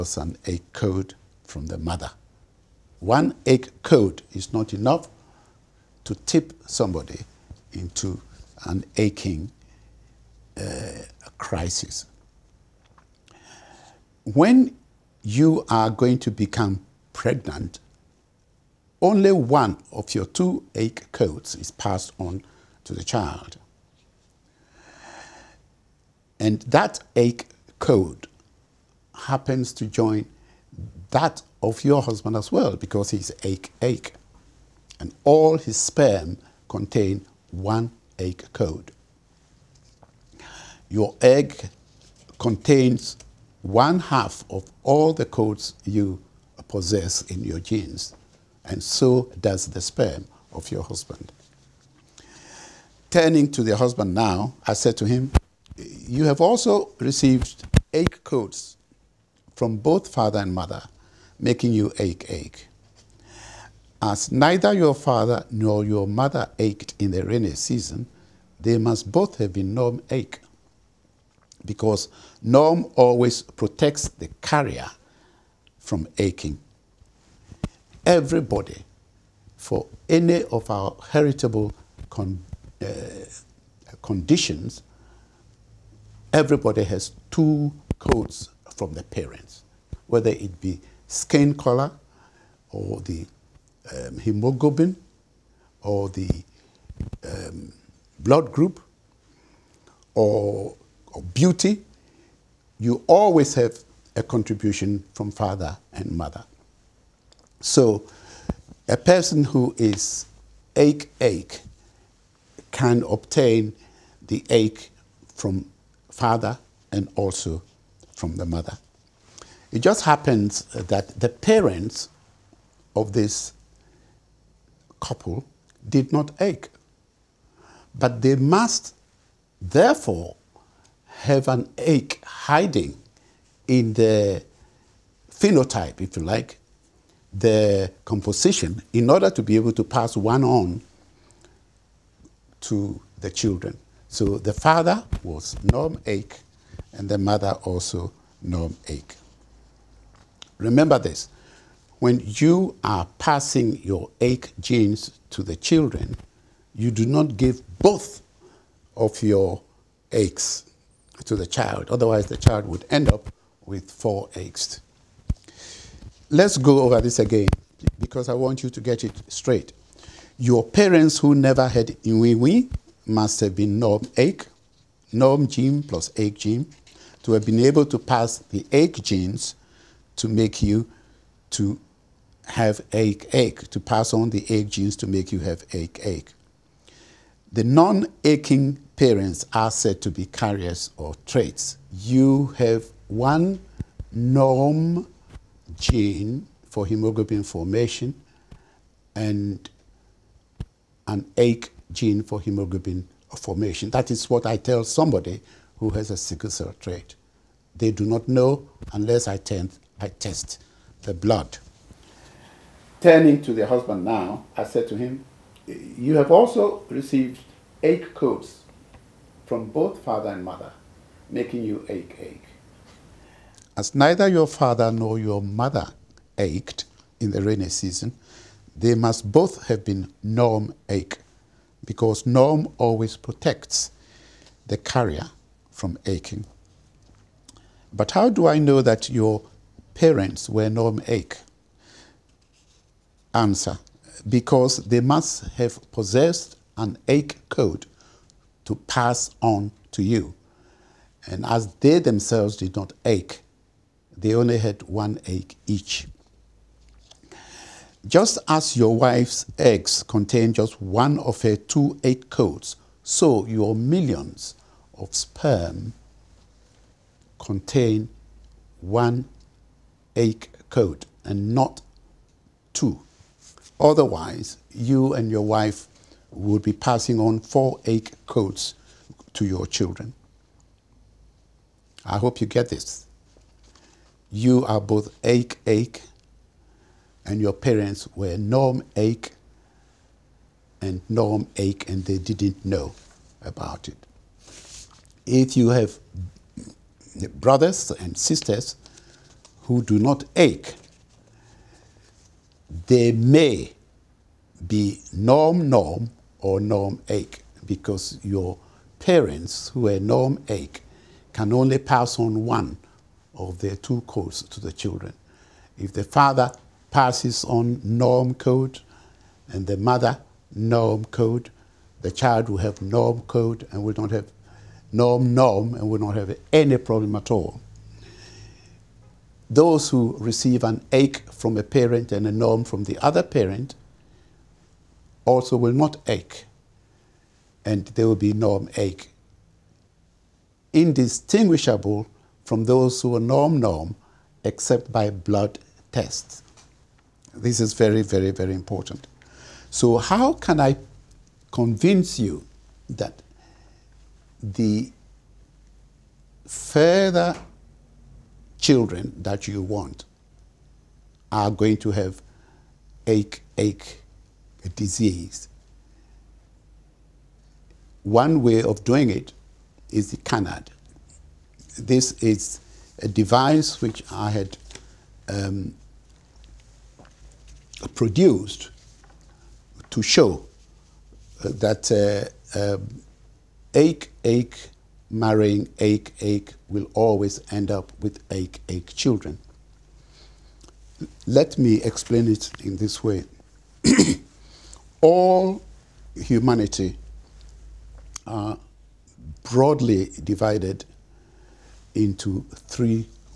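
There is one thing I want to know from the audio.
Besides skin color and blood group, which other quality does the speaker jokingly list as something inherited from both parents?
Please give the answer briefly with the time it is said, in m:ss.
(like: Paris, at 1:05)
beauty, at 1:41.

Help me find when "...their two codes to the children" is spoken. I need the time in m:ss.
5:13.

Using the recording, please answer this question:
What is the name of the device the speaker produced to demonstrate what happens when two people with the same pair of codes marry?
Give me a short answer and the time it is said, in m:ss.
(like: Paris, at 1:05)
kanad, at 6:10.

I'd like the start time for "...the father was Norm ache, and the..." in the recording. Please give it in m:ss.
2:24.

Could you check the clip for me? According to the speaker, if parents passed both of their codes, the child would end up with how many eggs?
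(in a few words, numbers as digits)
4.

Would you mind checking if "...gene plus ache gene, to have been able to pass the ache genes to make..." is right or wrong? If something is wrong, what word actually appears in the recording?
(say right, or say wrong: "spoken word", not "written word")
right.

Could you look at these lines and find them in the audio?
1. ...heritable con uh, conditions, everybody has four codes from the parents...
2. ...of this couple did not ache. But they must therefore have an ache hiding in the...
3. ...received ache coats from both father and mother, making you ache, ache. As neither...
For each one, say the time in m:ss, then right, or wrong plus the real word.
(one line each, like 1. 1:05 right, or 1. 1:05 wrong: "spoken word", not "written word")
1. 1:21 wrong: "two", not "four"
2. 2:02 right
3. 3:36 right.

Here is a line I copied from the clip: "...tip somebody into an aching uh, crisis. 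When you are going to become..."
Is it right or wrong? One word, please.
right.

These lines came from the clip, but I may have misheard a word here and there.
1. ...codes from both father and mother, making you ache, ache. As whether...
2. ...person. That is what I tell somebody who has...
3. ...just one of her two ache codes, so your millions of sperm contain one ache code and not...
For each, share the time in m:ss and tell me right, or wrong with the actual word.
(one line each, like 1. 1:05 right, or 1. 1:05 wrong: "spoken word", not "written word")
1. 0:58 wrong: "neither", not "whether"
2. 3:23 wrong: "formation", not "person"
3. 4:20 right.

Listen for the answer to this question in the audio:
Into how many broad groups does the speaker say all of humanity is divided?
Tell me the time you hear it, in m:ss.
6:42.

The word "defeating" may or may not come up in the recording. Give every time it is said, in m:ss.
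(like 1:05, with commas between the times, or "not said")
not said.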